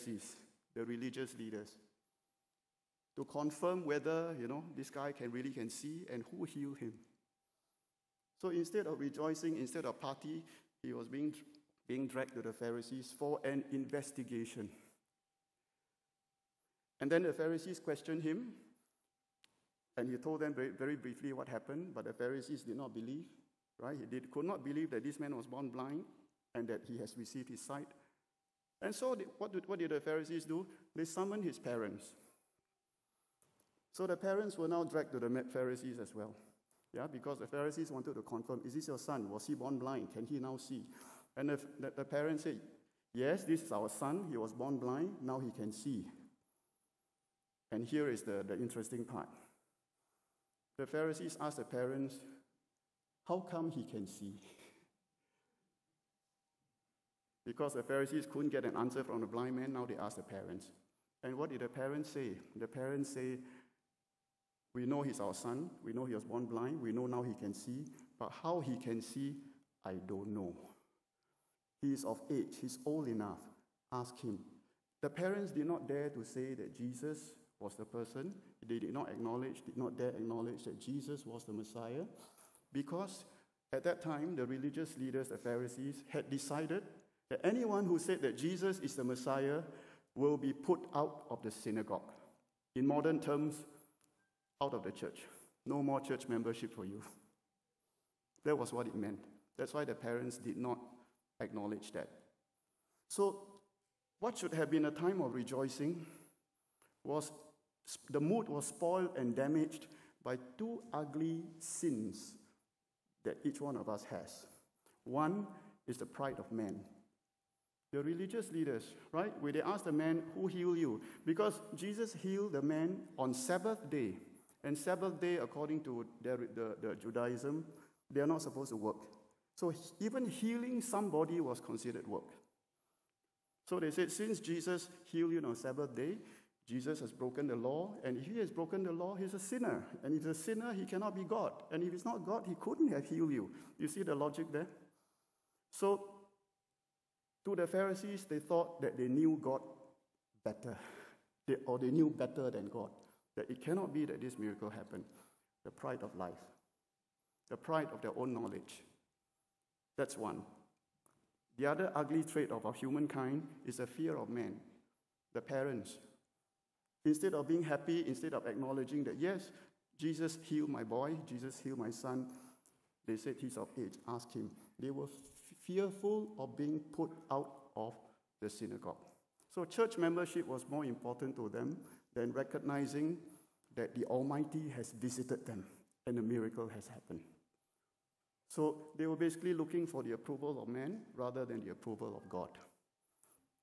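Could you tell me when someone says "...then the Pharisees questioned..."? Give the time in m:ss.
0:17.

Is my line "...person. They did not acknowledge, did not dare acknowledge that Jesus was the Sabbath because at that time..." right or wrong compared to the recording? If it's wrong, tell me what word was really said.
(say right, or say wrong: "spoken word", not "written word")
wrong: "Messiah", not "Sabbath".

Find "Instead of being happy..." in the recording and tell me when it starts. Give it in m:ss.
2:47.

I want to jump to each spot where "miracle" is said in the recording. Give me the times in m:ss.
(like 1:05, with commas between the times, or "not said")
2:34, 3:06.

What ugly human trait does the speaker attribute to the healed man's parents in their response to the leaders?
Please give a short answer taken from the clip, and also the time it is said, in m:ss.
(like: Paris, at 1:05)
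Fear of man, at 2:43.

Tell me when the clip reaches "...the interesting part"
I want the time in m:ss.
0:48.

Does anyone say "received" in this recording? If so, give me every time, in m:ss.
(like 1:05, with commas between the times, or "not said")
0:27.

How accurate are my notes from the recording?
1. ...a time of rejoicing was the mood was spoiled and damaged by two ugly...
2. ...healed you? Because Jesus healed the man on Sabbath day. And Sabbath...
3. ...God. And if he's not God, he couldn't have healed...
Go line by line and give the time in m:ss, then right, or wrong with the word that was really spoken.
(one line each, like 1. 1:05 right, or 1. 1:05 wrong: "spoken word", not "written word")
1. 1:44 right
2. 2:00 right
3. 2:21 right.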